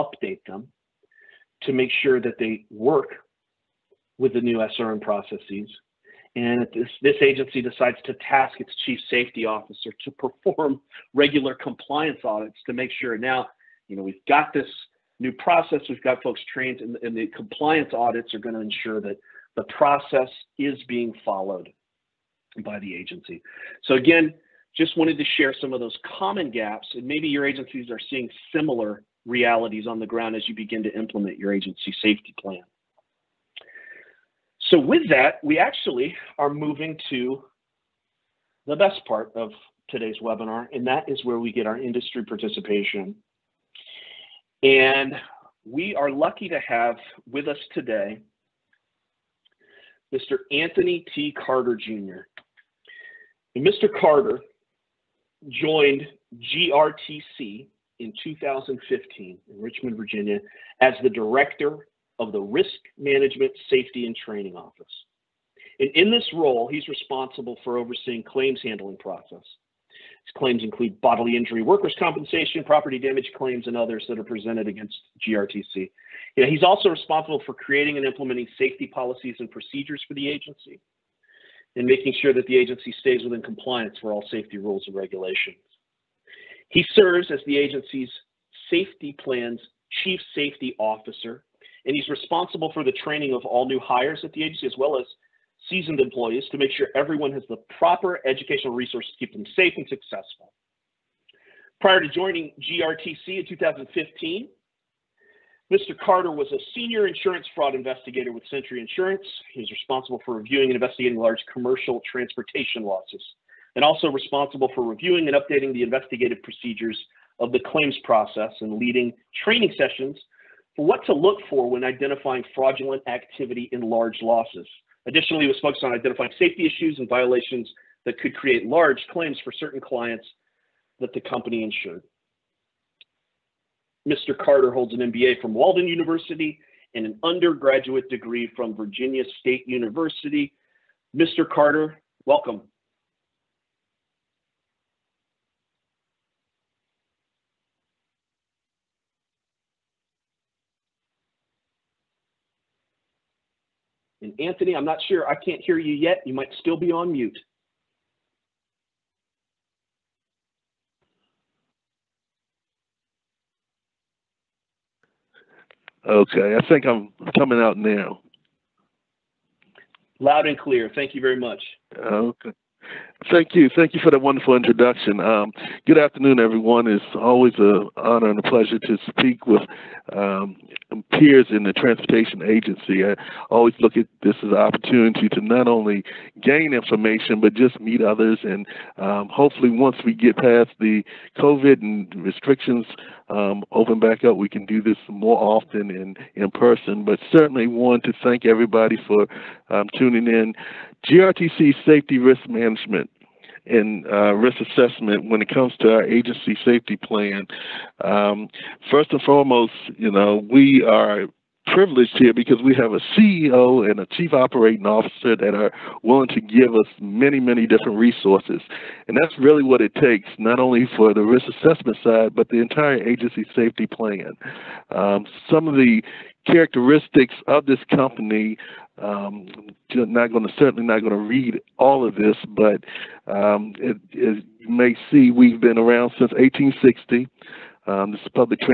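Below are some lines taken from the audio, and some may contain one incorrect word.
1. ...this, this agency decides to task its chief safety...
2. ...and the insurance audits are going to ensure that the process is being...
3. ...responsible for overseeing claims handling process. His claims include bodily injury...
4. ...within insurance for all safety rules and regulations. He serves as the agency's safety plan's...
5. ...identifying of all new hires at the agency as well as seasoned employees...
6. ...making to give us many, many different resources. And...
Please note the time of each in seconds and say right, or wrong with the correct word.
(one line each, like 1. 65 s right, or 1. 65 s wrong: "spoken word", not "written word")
1. 6 s right
2. 17 s wrong: "compliance", not "insurance"
3. 66 s right
4. 83 s wrong: "compliance", not "insurance"
5. 92 s wrong: "training", not "identifying"
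6. 216 s wrong: "willing", not "making".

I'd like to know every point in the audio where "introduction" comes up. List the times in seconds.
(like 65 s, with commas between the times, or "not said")
174 s.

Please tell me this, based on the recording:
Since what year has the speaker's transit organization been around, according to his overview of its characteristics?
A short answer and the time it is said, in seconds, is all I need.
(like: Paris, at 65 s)
1860, at 236 s.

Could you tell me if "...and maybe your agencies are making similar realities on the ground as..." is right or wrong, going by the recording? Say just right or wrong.
wrong.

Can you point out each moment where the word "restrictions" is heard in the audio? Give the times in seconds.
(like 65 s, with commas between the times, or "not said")
192 s.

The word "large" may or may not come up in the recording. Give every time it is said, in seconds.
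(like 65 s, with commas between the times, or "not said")
111 s, 123 s, 128 s.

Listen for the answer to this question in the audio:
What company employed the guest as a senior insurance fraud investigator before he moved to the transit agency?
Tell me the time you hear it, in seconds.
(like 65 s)
108 s.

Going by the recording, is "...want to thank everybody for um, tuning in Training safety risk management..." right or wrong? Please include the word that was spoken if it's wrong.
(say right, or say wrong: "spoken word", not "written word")
wrong: "GRTC", not "Training".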